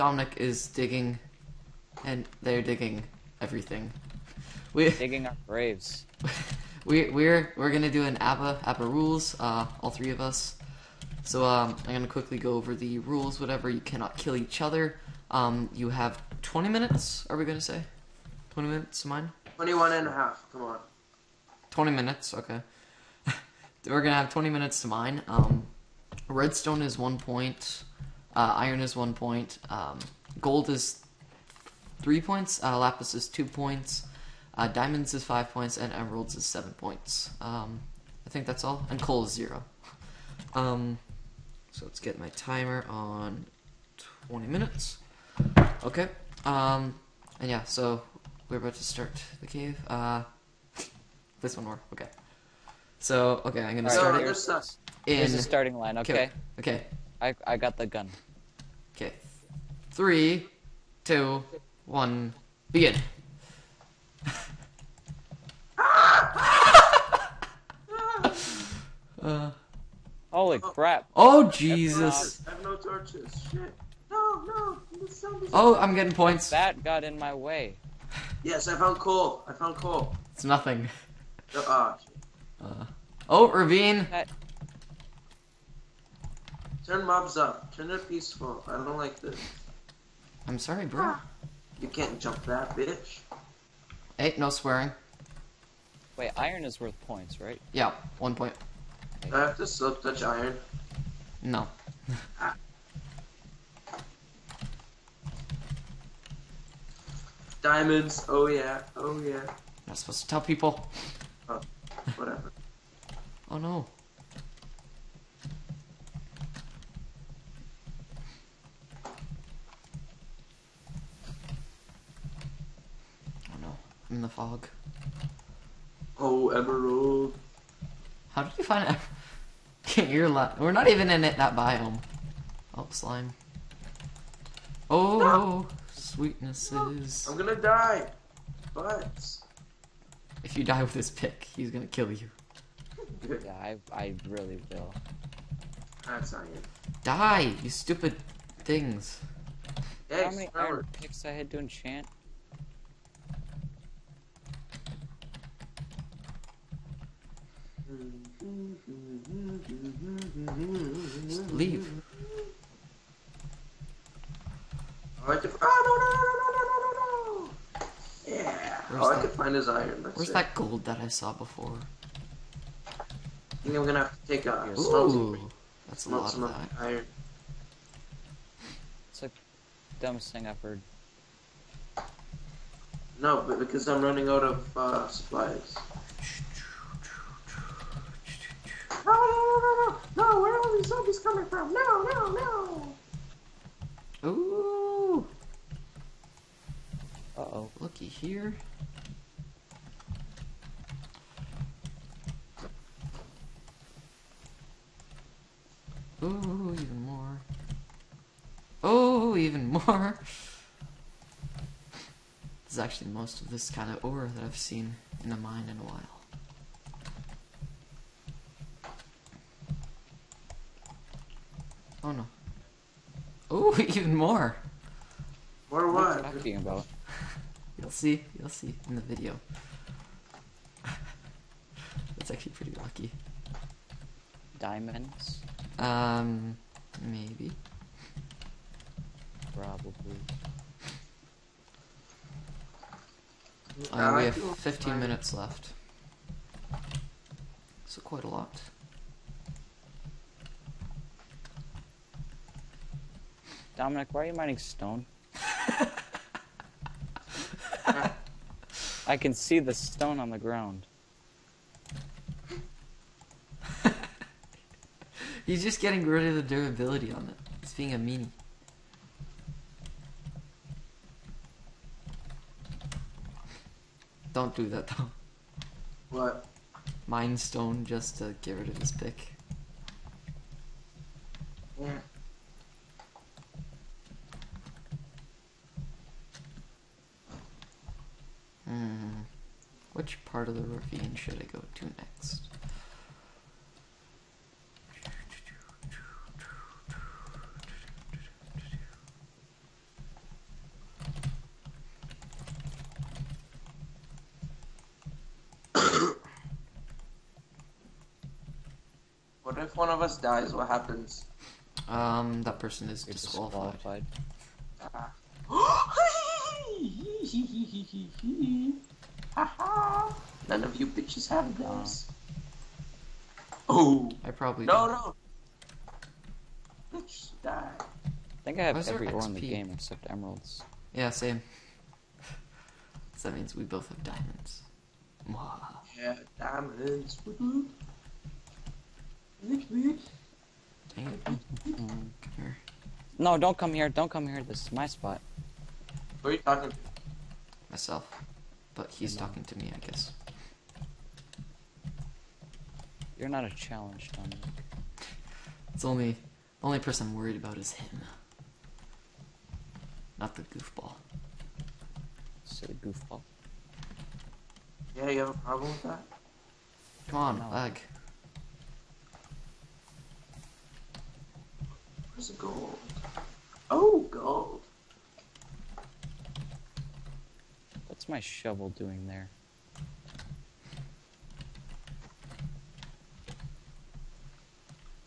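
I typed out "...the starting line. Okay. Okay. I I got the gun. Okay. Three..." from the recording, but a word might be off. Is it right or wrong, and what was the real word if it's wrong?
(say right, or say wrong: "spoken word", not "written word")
right.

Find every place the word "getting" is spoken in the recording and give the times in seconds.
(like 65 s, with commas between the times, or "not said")
75 s, 265 s.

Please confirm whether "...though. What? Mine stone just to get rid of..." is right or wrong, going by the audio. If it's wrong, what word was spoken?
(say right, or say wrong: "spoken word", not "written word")
right.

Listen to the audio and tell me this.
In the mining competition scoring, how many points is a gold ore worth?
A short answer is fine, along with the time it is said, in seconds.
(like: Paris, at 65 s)
3, at 30 s.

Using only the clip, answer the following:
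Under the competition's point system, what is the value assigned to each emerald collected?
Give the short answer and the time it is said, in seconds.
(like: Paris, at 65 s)
7, at 35 s.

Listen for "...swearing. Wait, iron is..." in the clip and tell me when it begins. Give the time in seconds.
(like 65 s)
94 s.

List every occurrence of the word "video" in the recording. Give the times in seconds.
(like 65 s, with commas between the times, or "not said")
229 s.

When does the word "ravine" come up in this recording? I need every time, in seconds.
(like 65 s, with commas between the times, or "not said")
83 s, 290 s.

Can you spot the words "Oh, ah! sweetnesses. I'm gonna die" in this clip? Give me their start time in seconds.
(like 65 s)
134 s.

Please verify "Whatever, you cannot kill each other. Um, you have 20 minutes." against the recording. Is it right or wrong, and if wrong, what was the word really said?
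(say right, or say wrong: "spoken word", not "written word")
right.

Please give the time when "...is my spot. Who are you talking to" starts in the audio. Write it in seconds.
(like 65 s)
344 s.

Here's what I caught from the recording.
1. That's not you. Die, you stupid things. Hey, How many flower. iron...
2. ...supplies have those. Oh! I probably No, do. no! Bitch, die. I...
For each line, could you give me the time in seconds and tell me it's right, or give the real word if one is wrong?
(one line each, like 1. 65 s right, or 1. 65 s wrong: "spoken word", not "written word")
1. 146 s right
2. 320 s wrong: "bitches", not "supplies".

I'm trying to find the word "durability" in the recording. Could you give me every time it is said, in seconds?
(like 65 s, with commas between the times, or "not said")
266 s.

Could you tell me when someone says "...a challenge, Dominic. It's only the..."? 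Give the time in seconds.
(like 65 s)
353 s.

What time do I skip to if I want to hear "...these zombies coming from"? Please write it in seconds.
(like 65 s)
190 s.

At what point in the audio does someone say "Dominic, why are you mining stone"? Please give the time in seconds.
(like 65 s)
253 s.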